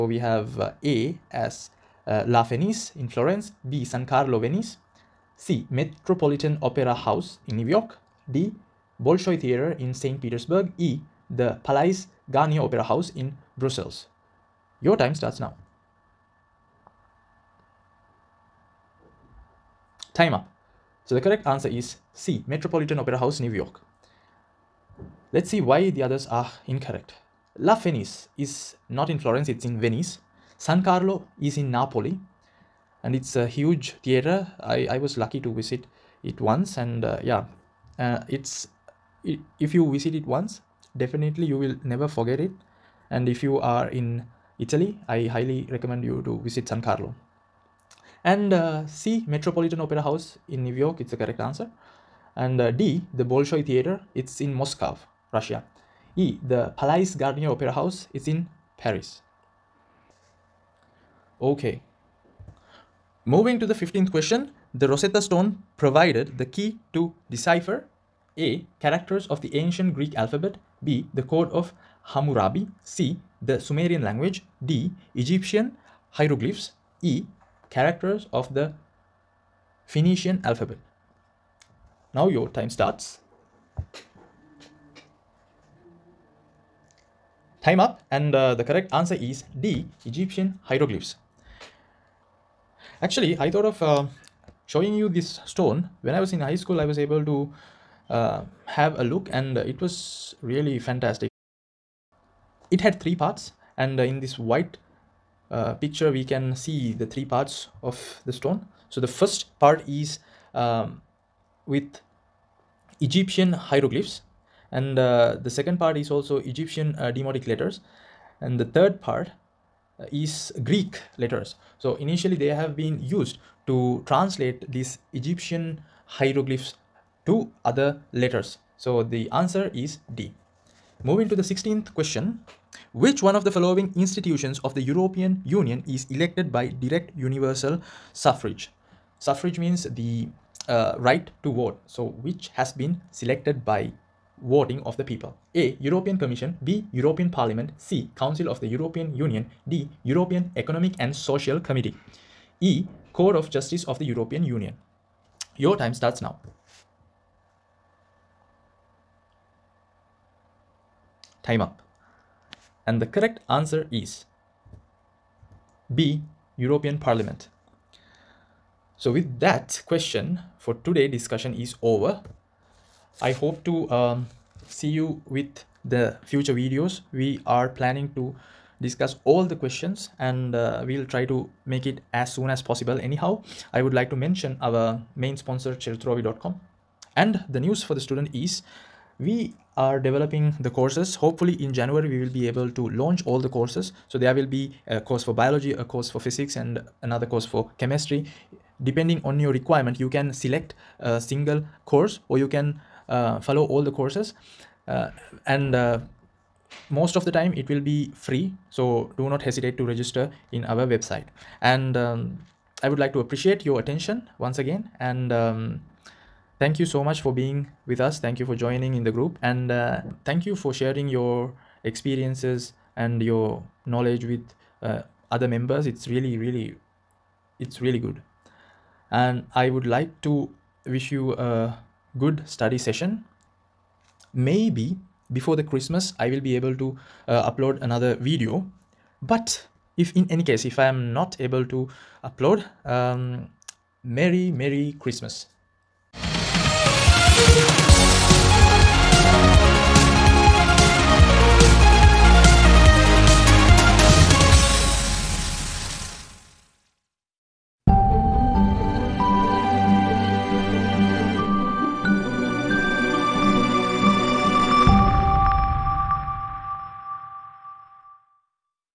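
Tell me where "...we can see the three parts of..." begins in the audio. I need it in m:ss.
1:46.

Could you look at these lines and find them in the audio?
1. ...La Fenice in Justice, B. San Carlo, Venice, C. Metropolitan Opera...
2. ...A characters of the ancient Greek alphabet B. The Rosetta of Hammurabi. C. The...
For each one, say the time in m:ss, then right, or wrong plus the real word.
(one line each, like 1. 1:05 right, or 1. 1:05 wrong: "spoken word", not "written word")
1. 0:02 wrong: "Florence", not "Justice"
2. 1:08 wrong: "Code", not "Rosetta".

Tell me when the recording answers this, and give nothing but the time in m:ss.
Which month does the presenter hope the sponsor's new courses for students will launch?
3:11.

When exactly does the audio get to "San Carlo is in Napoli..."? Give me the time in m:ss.
0:30.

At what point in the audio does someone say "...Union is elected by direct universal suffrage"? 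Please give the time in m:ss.
2:15.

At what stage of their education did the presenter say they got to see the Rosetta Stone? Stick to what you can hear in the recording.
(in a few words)
high school.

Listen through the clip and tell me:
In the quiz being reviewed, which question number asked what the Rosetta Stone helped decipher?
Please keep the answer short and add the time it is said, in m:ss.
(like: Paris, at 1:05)
15th, at 1:03.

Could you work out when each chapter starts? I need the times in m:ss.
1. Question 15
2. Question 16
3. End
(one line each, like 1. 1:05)
1. 1:04
2. 2:11
3. 2:53.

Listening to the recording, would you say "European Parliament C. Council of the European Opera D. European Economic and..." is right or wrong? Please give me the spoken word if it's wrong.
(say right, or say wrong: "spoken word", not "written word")
wrong: "Union", not "Opera".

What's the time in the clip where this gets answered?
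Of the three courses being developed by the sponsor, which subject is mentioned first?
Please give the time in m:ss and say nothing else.
3:15.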